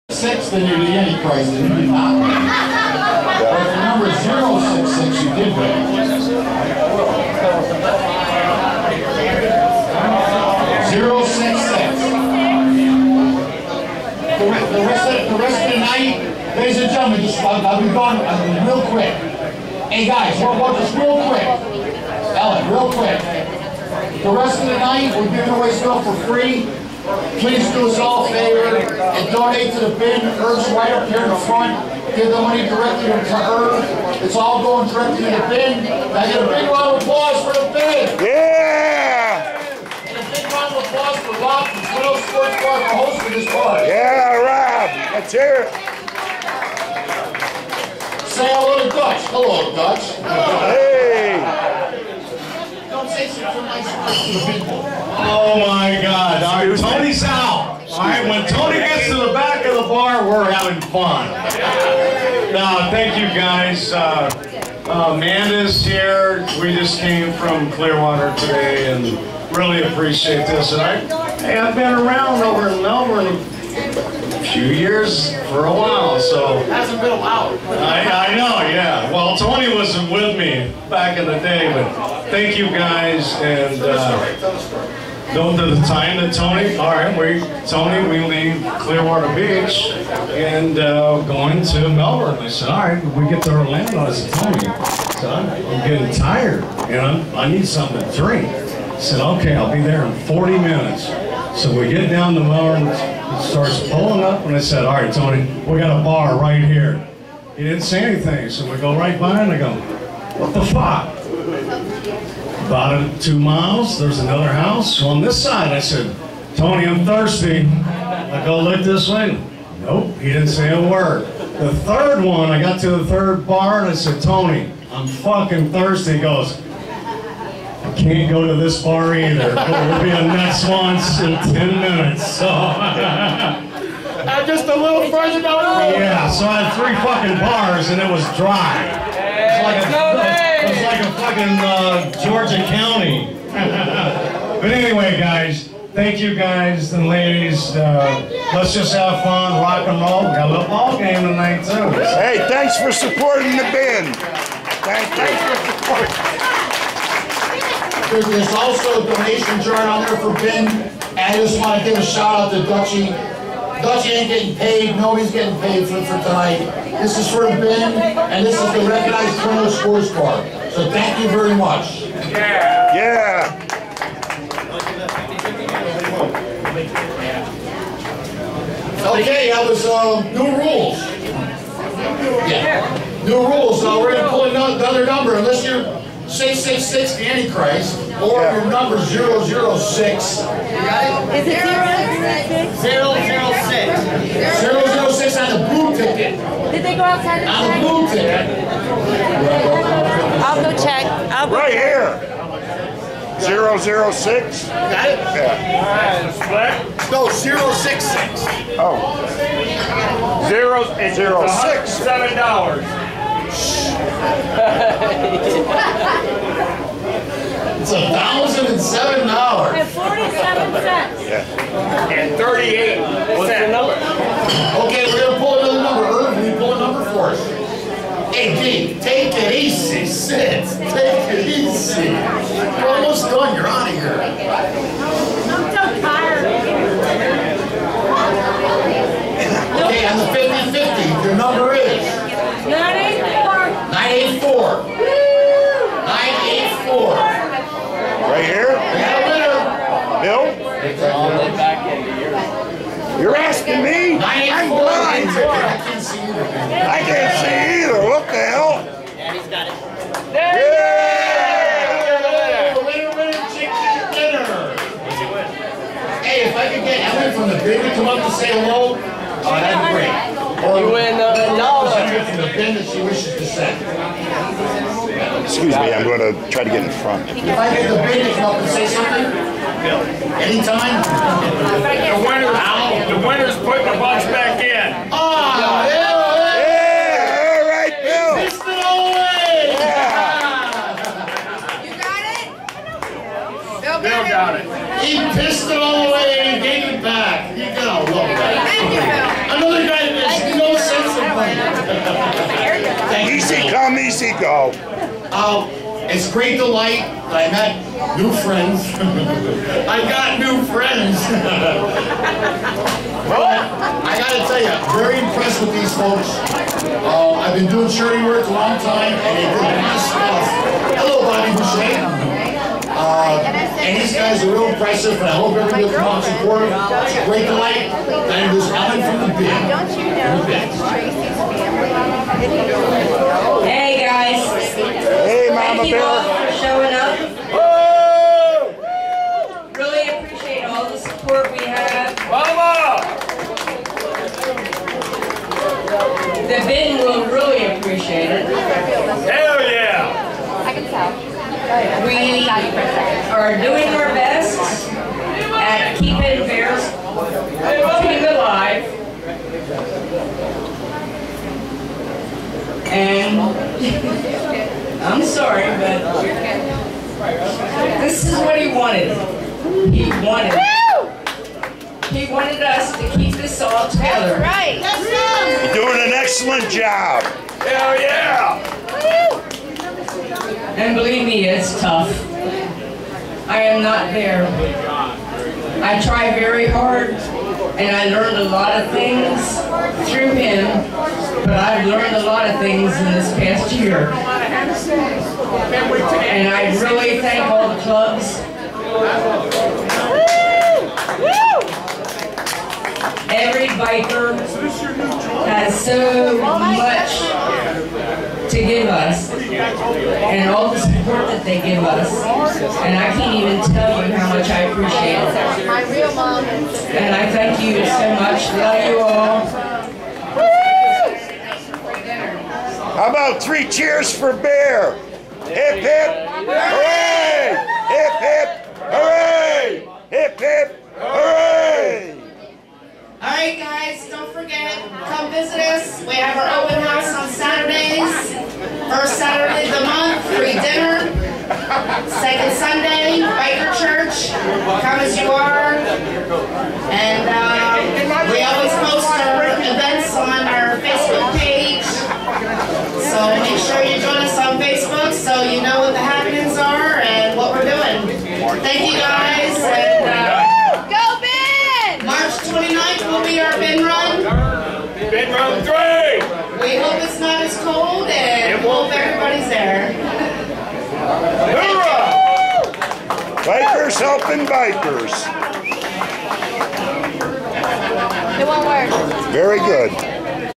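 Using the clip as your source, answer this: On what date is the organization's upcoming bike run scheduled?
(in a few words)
March 29.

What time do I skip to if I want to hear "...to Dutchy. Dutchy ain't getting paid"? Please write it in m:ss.
2:42.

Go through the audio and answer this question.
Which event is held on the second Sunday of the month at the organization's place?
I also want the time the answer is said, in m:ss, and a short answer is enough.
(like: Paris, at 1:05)
Biker Church, at 7:23.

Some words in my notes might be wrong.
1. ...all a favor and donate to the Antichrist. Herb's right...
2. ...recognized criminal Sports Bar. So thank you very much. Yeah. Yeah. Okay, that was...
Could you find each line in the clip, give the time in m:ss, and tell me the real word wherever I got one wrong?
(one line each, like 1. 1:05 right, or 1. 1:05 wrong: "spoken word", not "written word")
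1. 0:27 wrong: "BIN", not "Antichrist"
2. 2:48 right.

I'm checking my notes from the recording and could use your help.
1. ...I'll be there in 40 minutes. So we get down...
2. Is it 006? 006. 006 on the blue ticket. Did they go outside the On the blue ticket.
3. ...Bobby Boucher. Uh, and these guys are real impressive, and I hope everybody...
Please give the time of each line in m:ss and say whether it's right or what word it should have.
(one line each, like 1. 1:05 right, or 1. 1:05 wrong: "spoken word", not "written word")
1. 1:39 right
2. 3:11 right
3. 5:21 right.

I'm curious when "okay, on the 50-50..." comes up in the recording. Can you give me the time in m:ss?
3:59.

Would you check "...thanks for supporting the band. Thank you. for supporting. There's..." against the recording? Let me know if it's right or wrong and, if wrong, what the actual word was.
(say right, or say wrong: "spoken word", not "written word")
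right.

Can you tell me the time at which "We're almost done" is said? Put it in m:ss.
3:52.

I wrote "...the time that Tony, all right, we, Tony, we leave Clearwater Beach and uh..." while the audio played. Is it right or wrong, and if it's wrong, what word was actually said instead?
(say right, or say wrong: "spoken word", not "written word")
right.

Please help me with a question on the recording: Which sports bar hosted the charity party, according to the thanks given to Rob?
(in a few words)
Twin Oaks Sports Bar.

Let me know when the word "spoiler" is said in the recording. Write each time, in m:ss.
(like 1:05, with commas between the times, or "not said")
not said.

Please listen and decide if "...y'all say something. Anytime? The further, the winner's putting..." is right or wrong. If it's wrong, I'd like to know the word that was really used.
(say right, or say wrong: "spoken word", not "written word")
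wrong: "winner", not "further".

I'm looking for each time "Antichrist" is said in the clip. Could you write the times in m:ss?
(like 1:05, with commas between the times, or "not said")
0:01, 3:07.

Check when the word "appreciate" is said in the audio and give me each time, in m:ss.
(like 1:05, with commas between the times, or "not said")
1:09, 5:40, 5:47, 6:54.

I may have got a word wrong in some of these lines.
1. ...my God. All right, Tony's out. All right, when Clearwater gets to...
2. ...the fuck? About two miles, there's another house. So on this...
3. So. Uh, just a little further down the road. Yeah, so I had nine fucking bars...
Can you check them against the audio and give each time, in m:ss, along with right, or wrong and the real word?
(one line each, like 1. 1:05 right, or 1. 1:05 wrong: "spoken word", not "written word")
1. 0:55 wrong: "Tony", not "Clearwater"
2. 1:50 right
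3. 2:12 wrong: "three", not "nine".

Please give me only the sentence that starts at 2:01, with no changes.
The third one, I got to the third bar and I said, Tony, I'm fucking thirsty.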